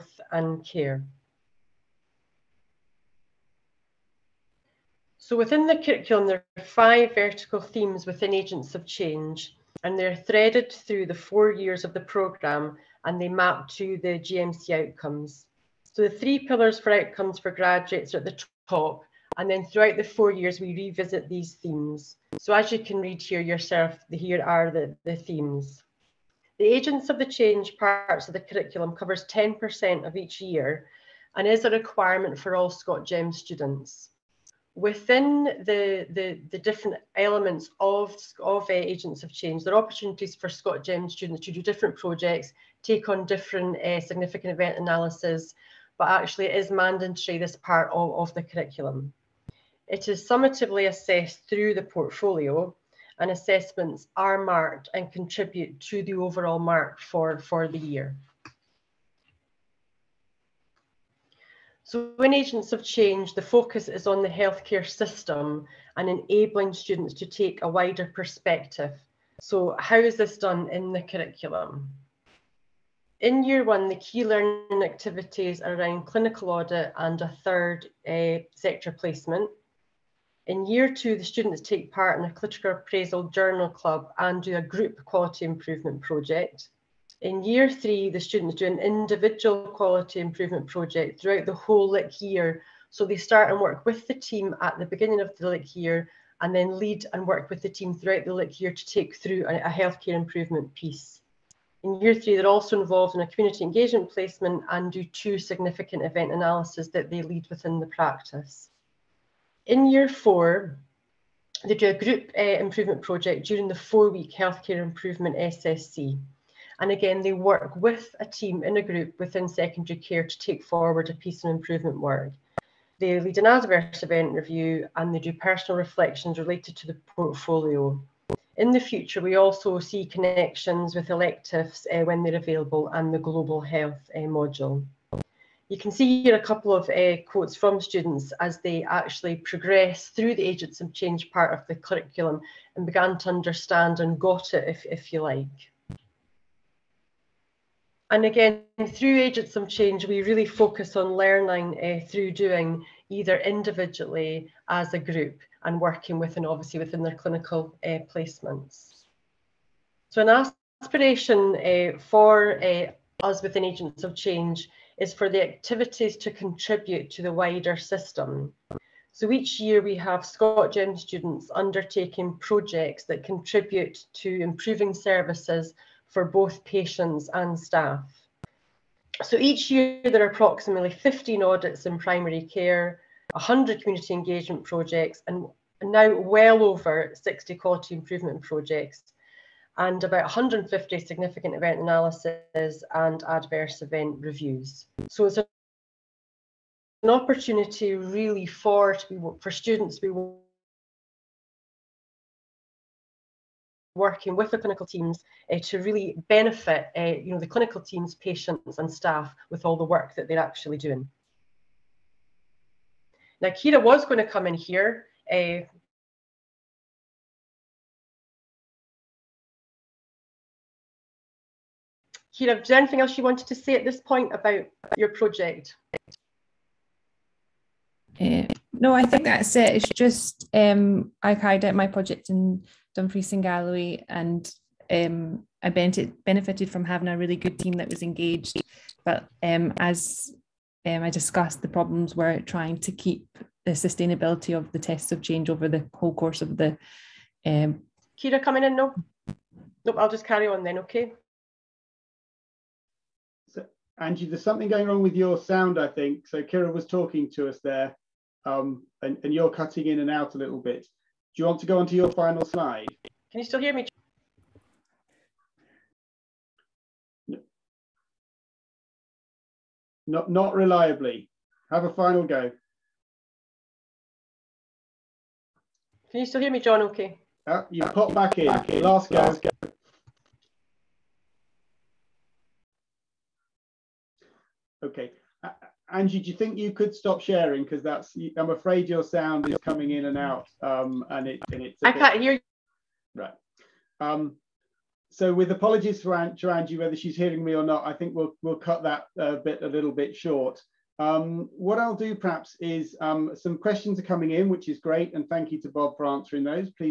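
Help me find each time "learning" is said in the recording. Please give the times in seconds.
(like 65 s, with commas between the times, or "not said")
74 s, 151 s.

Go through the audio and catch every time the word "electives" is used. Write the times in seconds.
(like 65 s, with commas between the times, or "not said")
131 s.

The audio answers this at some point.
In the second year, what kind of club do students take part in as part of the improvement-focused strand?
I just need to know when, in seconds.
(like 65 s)
82 s.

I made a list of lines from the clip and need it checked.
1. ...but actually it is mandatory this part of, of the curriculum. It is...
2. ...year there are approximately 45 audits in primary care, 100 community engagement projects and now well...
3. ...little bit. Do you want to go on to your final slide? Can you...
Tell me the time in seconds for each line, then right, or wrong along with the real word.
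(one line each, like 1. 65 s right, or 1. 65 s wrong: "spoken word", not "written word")
1. 45 s right
2. 179 s wrong: "15", not "45"
3. 260 s right.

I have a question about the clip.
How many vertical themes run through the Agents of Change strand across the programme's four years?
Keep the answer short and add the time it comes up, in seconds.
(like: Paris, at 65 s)
5, at 6 s.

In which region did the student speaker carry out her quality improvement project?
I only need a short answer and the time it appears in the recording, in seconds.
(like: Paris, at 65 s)
Dumfries and Galloway, at 232 s.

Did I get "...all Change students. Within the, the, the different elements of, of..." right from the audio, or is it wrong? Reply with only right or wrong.
wrong.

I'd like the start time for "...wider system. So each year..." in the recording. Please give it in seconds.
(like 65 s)
167 s.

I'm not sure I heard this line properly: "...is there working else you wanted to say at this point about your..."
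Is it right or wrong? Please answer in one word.
wrong.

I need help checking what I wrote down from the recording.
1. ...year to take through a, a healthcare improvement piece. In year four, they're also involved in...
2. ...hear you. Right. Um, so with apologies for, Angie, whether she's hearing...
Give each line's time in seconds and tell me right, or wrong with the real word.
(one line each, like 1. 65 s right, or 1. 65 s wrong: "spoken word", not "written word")
1. 98 s wrong: "three", not "four"
2. 292 s right.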